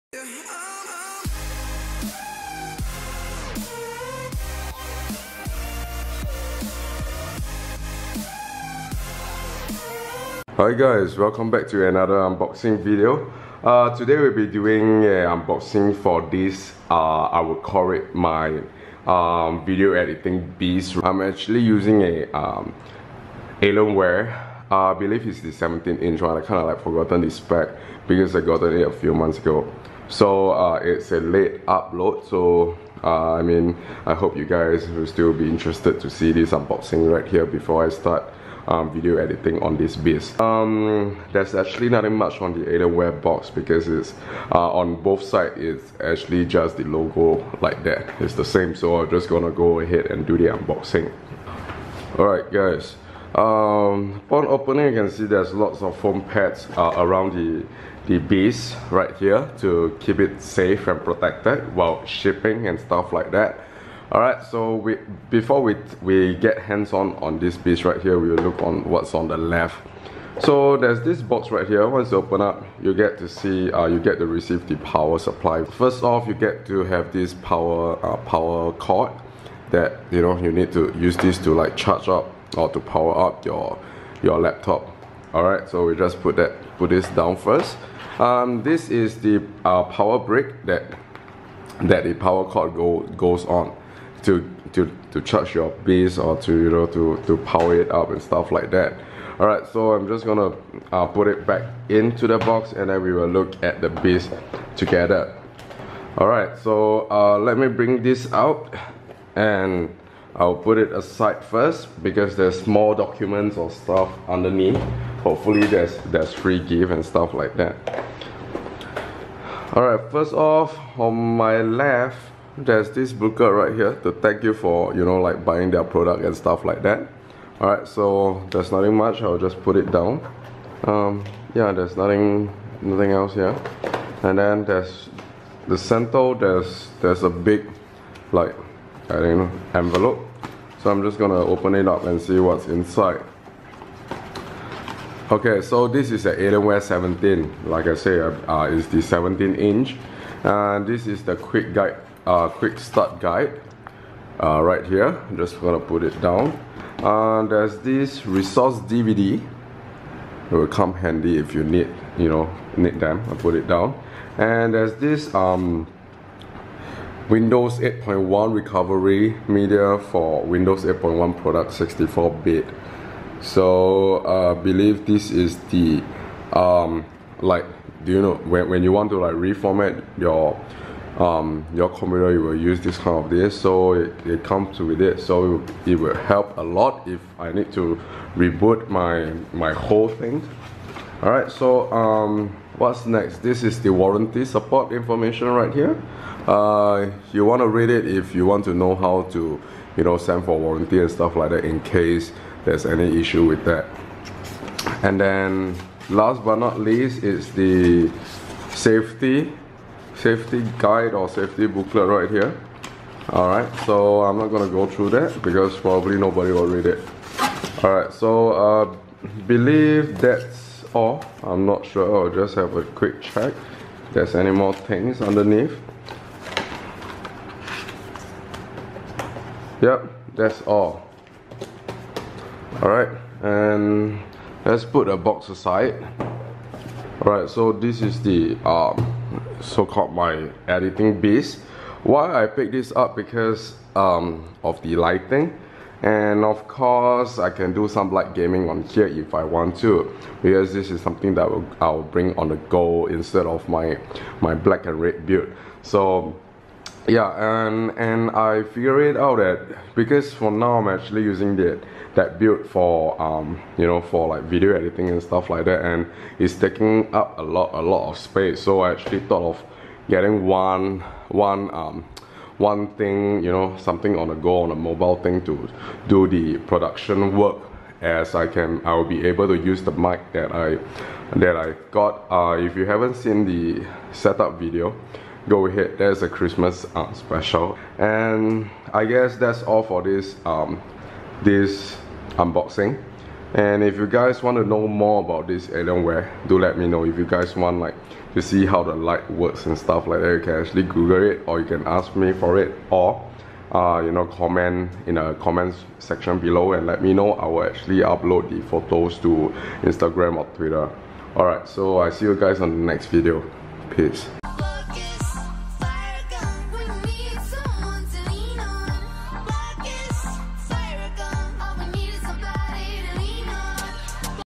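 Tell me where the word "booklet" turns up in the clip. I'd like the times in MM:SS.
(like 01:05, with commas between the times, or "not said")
02:03, 03:31.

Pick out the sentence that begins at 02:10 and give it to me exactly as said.
Um, yeah, there's nothing nothing else here.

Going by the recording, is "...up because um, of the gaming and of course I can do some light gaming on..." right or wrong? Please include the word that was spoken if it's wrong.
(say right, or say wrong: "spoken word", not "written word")
wrong: "lighting", not "gaming".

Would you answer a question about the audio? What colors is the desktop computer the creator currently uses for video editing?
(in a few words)
black and red.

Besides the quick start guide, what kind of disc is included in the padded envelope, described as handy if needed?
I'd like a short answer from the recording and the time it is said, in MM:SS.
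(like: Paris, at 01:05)
resource DVD, at 02:38.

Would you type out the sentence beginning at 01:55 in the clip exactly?
Hopefully there's there's free gift and stuff like that.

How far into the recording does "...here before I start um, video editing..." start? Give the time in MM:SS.
00:37.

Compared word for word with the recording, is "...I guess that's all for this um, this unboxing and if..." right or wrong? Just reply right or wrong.
right.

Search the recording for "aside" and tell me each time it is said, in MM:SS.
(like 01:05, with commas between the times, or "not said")
01:50, 03:55.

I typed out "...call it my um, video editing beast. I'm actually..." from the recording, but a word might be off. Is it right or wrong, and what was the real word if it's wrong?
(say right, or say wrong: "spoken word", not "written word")
right.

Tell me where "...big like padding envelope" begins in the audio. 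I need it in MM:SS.
02:17.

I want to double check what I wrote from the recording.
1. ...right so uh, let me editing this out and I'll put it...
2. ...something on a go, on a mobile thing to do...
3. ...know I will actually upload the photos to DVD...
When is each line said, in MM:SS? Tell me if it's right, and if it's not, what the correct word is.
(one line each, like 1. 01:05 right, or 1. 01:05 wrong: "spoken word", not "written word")
1. 01:46 wrong: "bring", not "editing"
2. 04:33 right
3. 05:07 wrong: "Instagram", not "DVD".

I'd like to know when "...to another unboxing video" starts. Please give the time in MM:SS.
00:11.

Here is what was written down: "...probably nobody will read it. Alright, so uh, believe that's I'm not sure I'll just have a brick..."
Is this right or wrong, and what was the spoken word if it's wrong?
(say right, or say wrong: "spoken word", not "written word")
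wrong: "quick", not "brick".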